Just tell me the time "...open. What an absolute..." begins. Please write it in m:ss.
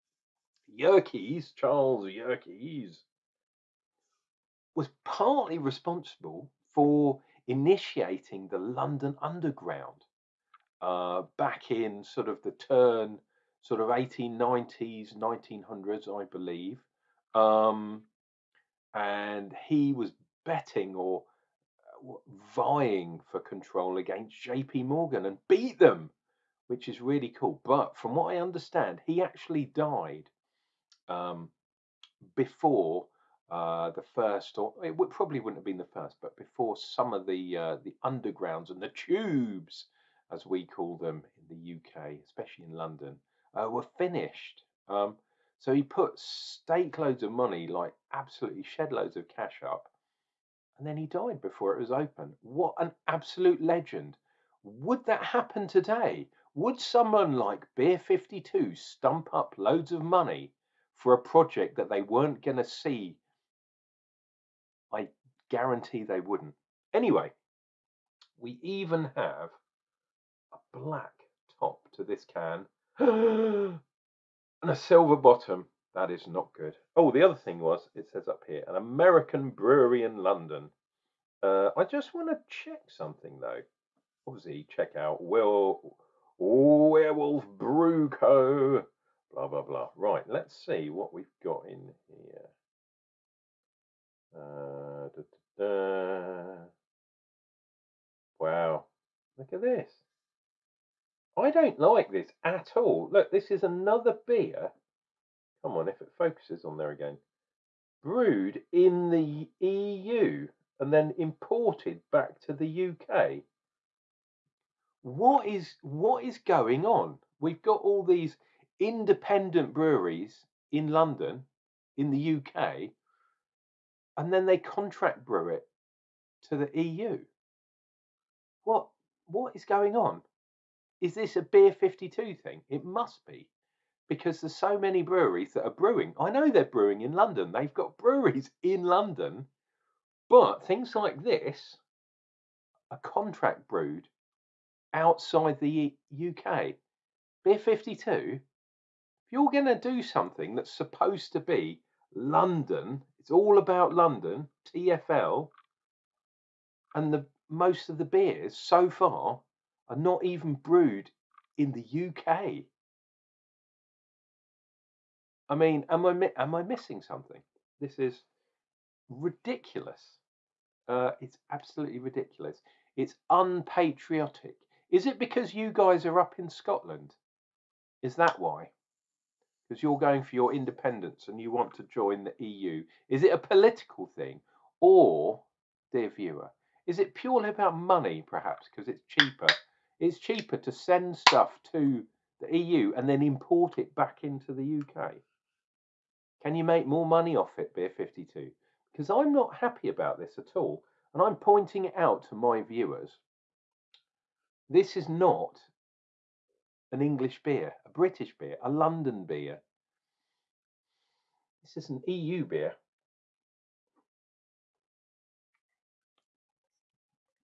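0:51.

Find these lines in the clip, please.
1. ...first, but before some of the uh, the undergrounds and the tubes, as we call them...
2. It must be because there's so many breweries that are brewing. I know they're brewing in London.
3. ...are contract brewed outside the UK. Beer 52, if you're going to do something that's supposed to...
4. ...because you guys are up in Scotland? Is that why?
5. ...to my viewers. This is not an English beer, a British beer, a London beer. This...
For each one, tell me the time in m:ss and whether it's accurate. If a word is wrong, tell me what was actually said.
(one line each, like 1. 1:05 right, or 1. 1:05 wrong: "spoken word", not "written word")
1. 0:35 right
2. 2:12 right
3. 2:22 right
4. 2:55 right
5. 3:22 right.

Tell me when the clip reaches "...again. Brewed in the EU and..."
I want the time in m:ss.
1:46.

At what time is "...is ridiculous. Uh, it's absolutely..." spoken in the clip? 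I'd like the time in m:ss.
2:47.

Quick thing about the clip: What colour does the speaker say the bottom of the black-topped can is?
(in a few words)
Silver.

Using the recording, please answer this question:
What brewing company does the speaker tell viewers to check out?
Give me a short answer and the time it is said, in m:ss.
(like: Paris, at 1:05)
Will Werewolf Brew Co, at 1:25.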